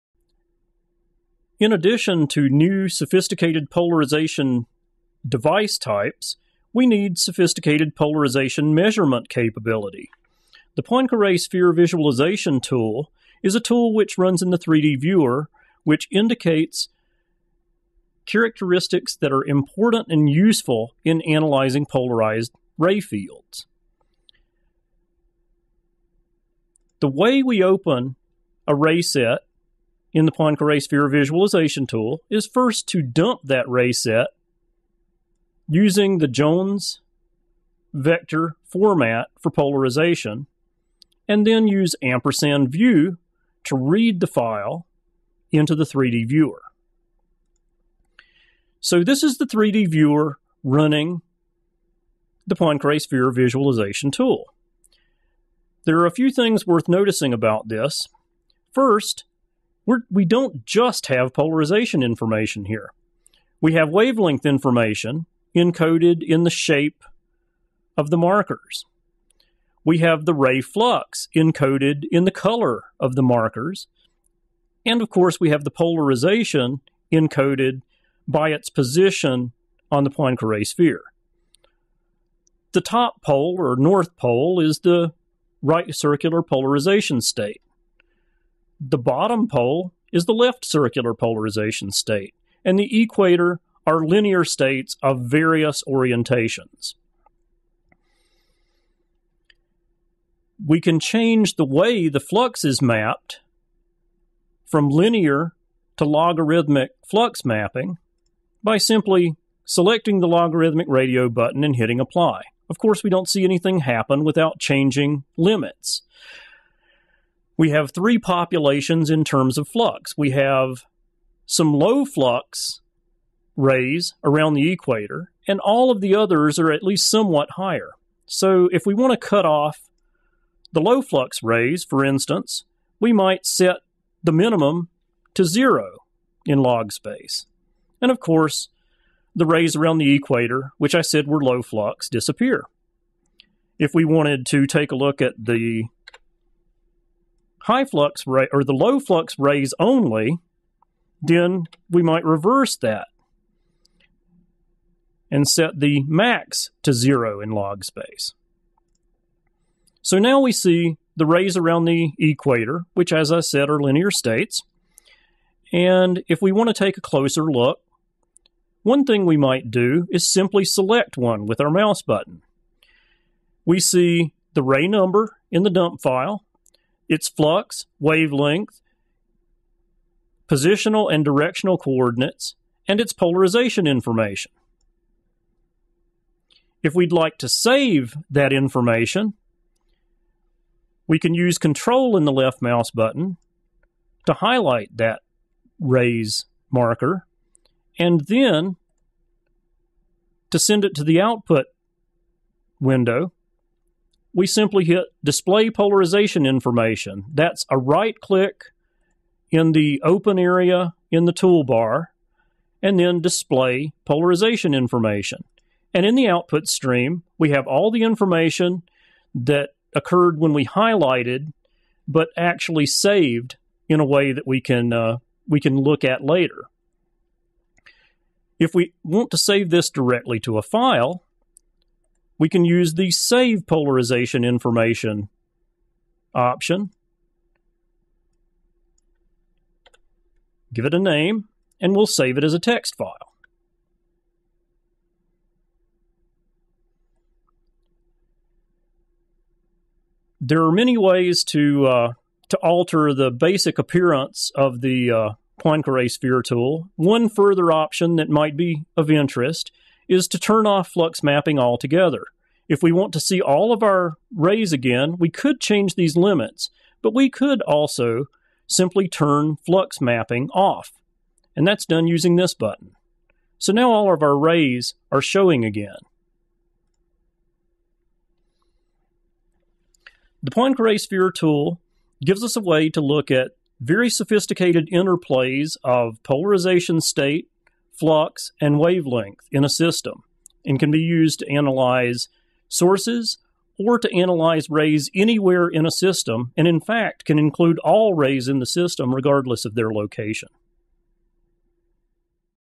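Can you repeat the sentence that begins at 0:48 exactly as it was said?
So this is the 3D viewer running the Poincare Sphere Visualization tool.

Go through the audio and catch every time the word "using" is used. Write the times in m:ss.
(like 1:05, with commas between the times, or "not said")
0:35, 4:32.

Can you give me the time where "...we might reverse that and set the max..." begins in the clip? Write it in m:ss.
2:31.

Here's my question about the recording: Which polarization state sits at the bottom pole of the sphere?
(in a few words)
Left circular polarization.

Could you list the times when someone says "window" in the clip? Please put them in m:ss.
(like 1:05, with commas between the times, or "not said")
3:22.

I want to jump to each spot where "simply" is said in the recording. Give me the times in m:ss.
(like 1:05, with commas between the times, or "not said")
1:48, 2:50, 3:24, 4:28.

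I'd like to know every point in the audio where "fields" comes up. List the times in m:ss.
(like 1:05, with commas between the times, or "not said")
0:22.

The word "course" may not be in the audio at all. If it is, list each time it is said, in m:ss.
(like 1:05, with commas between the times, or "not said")
1:15, 1:52, 2:18.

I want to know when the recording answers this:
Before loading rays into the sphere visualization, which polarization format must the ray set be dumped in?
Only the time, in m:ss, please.
0:36.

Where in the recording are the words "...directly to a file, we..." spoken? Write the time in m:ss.
3:49.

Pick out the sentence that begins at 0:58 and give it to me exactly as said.
First, we're, we don't just have polarization information here.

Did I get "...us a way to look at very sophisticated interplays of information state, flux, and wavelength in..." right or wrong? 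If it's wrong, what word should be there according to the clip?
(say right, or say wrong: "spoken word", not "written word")
wrong: "polarization", not "information".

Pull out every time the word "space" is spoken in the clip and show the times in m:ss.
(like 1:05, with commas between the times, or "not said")
2:16, 2:37.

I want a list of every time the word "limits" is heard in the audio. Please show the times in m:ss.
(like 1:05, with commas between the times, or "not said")
1:55, 4:26.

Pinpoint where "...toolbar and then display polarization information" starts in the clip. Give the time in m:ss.
3:31.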